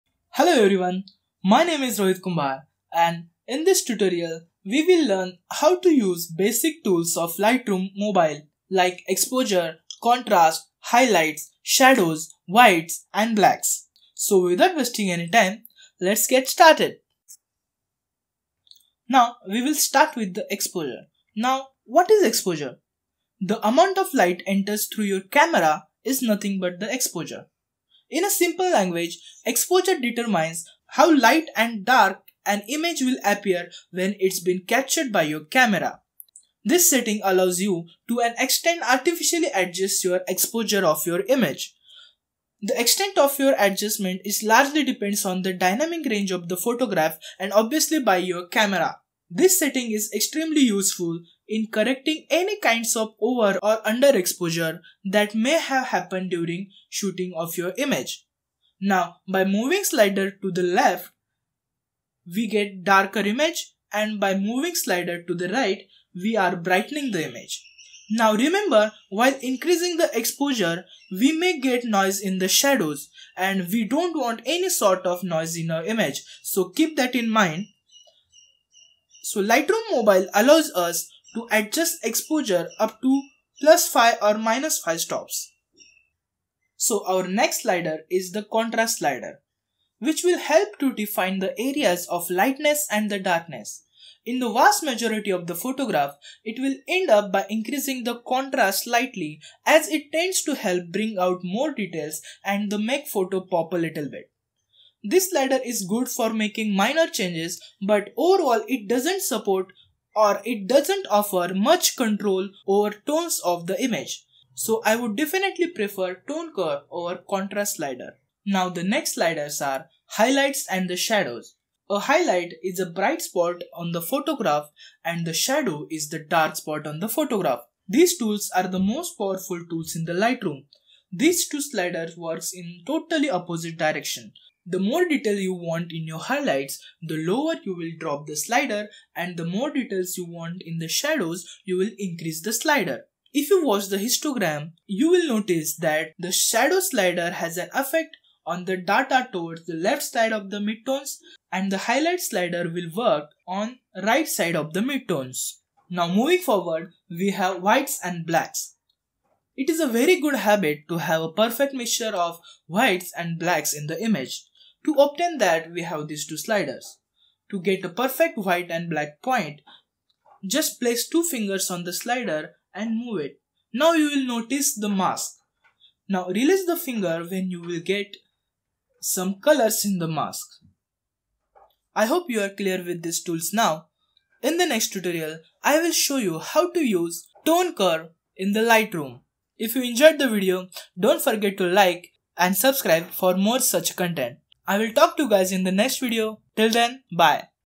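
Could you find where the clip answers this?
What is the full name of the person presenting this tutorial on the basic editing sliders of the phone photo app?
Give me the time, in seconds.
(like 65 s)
1 s.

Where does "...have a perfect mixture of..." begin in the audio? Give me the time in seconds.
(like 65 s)
160 s.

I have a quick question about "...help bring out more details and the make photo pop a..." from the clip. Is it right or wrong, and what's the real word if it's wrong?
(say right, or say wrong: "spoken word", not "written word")
right.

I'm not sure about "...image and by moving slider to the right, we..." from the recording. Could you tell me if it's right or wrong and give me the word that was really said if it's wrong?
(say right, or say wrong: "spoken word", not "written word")
right.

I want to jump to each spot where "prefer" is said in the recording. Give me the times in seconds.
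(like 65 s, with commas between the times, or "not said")
115 s.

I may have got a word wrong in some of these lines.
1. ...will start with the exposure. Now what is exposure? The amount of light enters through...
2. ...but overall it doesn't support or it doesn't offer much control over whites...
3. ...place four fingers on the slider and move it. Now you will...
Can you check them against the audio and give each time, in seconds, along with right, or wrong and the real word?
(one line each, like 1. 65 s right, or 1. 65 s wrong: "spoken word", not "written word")
1. 19 s right
2. 107 s wrong: "tones", not "whites"
3. 170 s wrong: "two", not "four".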